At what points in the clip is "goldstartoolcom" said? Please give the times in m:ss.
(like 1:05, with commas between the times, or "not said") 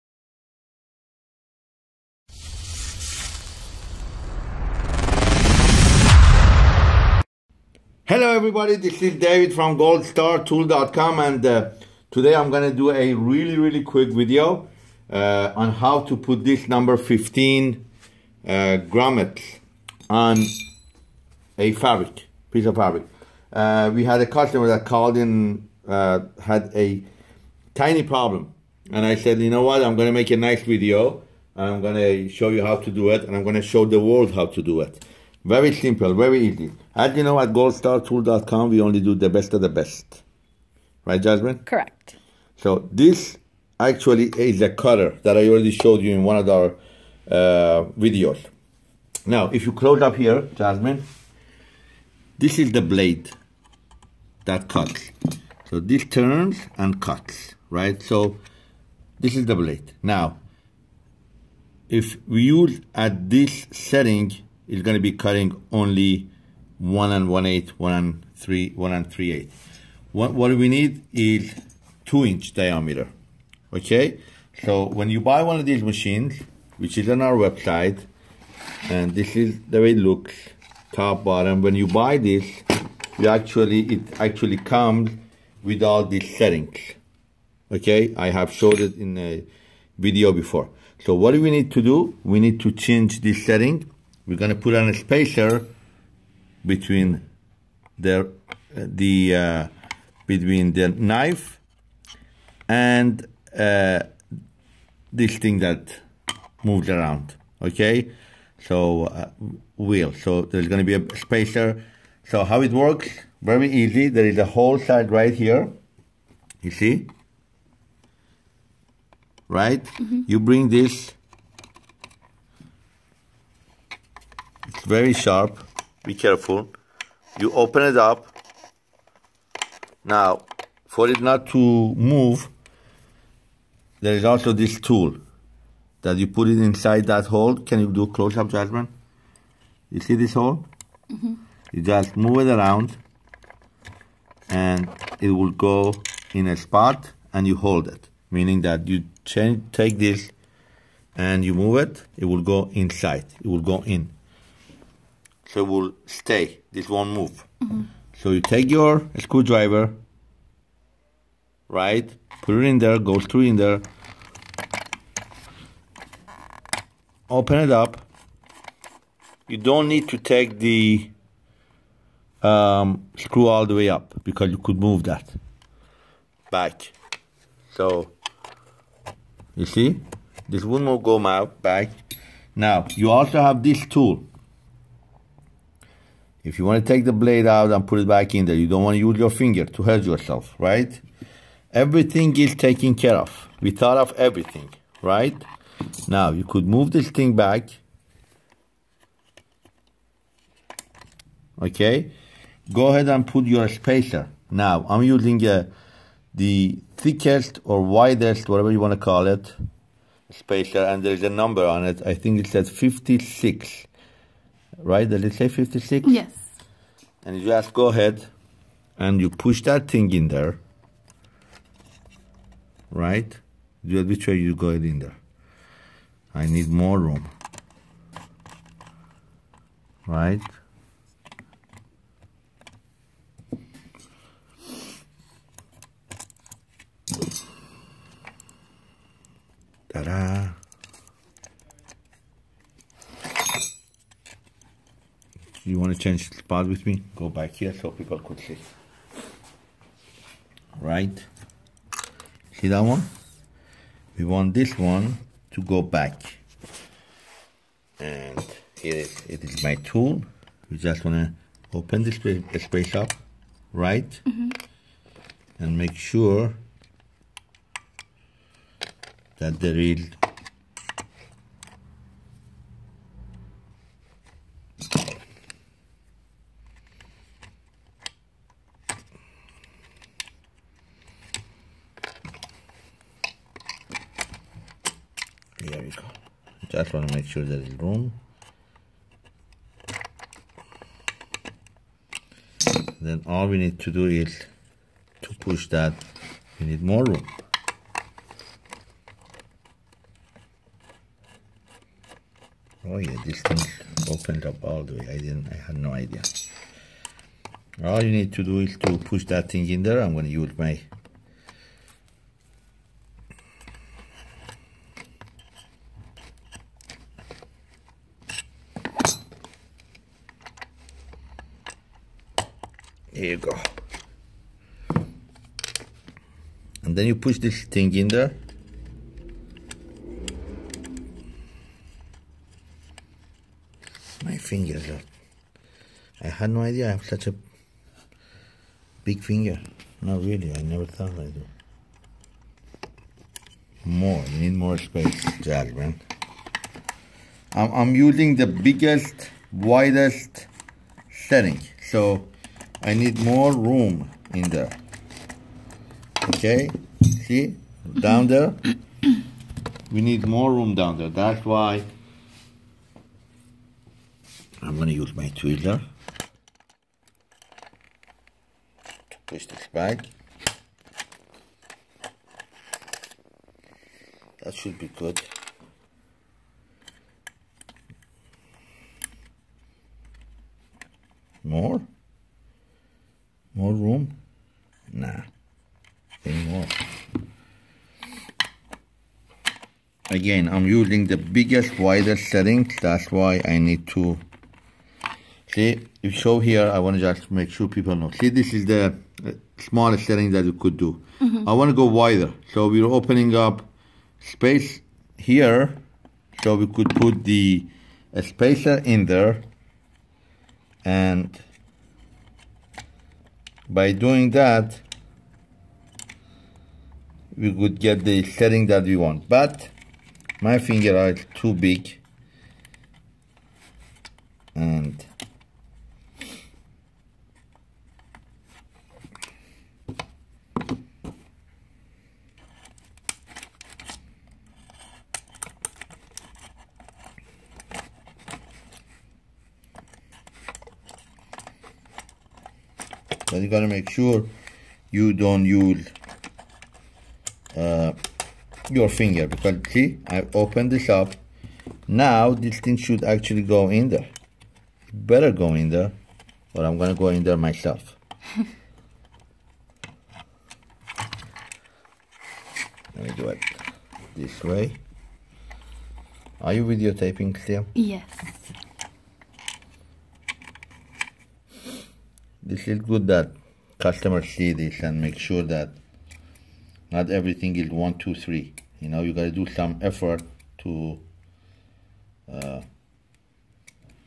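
0:09, 0:37.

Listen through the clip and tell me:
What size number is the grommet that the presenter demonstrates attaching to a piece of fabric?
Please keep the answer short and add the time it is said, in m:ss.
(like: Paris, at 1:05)
15, at 0:16.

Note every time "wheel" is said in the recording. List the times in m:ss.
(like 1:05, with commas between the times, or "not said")
1:49.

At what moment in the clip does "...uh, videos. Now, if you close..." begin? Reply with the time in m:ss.
0:47.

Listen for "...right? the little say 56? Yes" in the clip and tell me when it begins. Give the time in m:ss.
3:34.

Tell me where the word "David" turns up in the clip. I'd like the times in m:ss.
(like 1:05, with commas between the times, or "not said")
0:09.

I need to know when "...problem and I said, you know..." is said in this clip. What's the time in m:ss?
0:28.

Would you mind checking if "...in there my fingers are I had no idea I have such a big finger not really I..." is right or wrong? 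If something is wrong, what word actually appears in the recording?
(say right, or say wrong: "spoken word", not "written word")
right.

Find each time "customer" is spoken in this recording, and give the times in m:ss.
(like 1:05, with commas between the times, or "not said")
0:24, 7:53.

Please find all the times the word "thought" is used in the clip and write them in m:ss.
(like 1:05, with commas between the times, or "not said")
3:13, 5:40.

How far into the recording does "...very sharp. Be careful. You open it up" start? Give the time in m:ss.
2:04.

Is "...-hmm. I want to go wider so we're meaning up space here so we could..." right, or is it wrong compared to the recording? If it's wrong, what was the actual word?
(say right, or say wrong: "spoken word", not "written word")
wrong: "opening", not "meaning".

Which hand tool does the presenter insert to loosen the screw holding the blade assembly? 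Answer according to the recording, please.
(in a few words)
screwdriver.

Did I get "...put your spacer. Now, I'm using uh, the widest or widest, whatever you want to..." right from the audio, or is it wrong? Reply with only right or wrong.
wrong.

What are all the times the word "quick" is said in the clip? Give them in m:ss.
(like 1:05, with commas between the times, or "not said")
0:13.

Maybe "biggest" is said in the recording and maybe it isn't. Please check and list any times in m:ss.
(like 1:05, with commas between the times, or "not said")
5:48, 6:31.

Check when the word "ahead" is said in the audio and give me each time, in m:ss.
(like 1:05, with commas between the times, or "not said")
3:22, 3:37.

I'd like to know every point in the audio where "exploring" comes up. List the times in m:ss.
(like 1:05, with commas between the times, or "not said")
not said.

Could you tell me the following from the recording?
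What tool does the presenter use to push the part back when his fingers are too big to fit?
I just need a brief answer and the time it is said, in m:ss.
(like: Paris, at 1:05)
tweezer, at 6:05.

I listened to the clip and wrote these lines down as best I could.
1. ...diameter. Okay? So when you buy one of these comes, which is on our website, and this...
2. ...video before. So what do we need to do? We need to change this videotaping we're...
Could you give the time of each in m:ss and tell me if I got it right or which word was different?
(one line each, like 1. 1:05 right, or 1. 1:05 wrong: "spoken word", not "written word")
1. 1:12 wrong: "machines", not "comes"
2. 1:29 wrong: "setting", not "videotaping".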